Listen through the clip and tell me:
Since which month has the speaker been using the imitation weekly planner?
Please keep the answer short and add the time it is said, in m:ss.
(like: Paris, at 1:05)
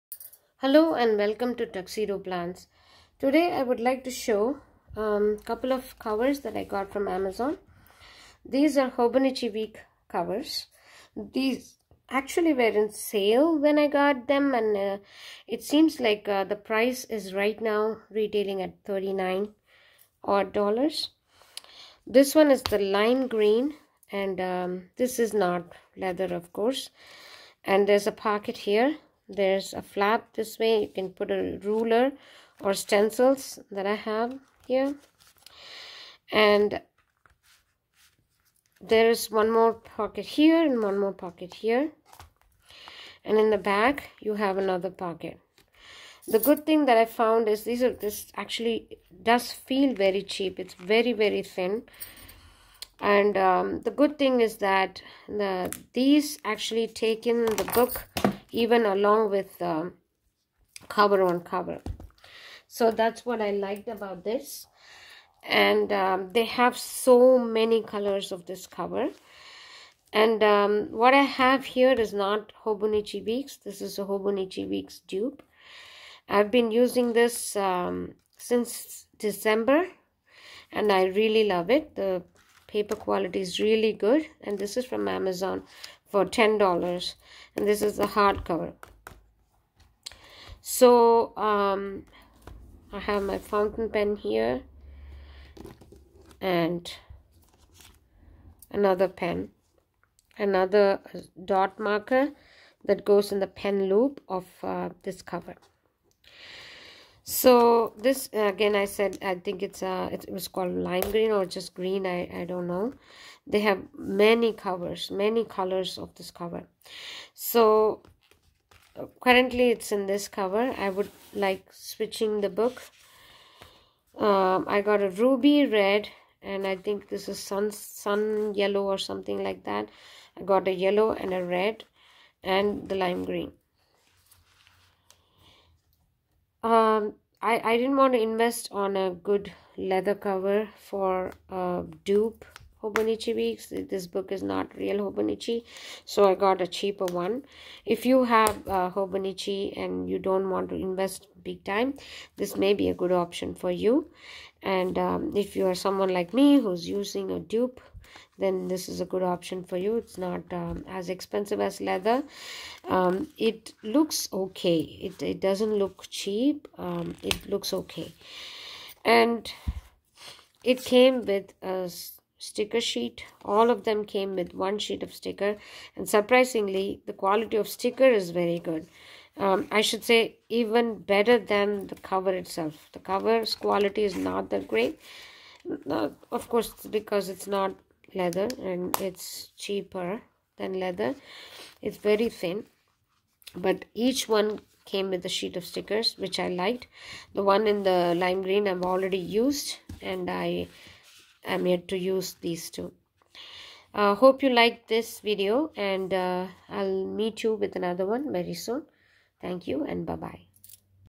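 December, at 1:19.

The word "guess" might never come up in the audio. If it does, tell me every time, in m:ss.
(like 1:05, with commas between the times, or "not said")
not said.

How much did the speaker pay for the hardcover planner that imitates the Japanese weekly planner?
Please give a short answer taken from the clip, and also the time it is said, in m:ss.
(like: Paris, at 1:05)
$10, at 1:26.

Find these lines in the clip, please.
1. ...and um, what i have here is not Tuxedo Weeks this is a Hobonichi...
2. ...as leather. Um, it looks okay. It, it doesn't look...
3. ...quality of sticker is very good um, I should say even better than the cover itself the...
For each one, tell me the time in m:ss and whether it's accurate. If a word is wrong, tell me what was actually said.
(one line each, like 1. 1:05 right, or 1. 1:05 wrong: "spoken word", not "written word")
1. 1:10 wrong: "Hobonichi", not "Tuxedo"
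2. 2:41 right
3. 2:57 right.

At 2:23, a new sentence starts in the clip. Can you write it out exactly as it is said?
This book is not real Hobonichi, so I got a cheaper one.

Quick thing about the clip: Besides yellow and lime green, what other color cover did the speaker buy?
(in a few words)
Ruby red.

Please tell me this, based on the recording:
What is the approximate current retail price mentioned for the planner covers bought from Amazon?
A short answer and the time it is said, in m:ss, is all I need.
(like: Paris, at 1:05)
39 dollars, at 0:18.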